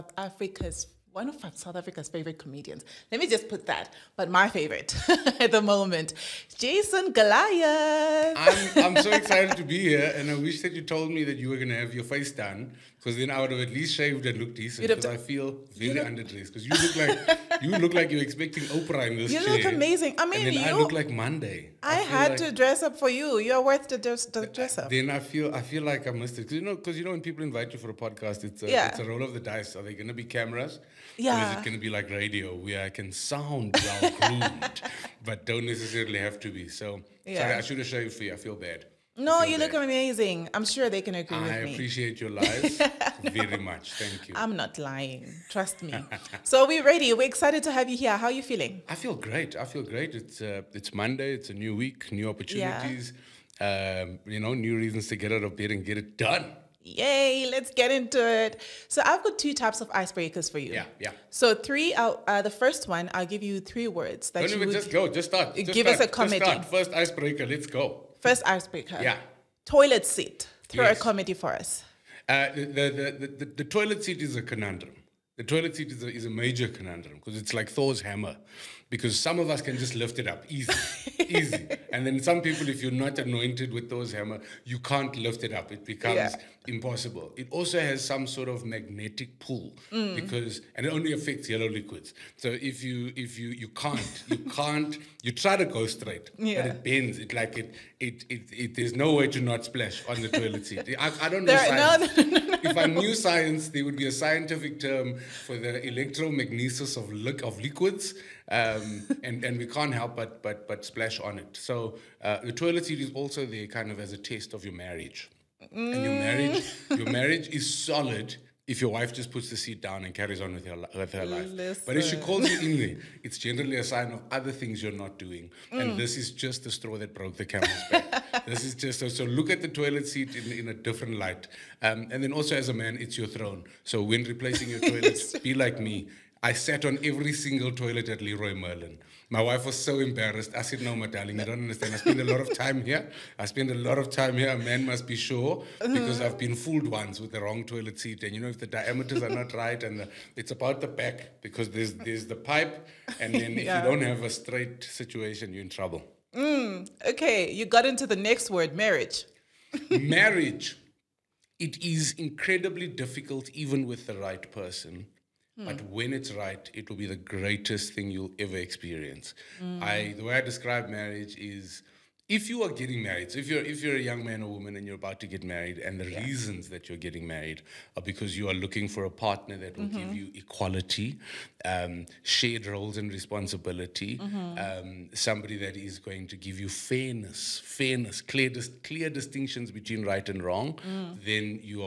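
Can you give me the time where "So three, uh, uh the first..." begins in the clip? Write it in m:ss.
1:01.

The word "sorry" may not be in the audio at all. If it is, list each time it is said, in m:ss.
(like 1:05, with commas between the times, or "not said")
0:37.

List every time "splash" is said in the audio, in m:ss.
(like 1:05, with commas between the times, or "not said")
1:39, 1:50.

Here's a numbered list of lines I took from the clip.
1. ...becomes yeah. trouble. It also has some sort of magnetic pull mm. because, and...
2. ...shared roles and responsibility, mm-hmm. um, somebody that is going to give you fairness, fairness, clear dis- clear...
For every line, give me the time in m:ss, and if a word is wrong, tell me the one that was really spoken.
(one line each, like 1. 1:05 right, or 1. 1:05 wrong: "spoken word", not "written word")
1. 1:25 wrong: "impossible", not "trouble"
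2. 3:02 right.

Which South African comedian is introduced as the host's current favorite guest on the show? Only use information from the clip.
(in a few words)
Jason Goliath.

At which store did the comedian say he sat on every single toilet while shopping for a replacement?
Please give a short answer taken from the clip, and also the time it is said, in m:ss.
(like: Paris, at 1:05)
Leroy Merlin, at 2:18.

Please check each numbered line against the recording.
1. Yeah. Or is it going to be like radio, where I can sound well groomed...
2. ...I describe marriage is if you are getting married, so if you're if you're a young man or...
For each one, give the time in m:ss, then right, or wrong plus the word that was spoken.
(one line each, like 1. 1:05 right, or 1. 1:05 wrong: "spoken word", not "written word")
1. 0:31 right
2. 2:50 right.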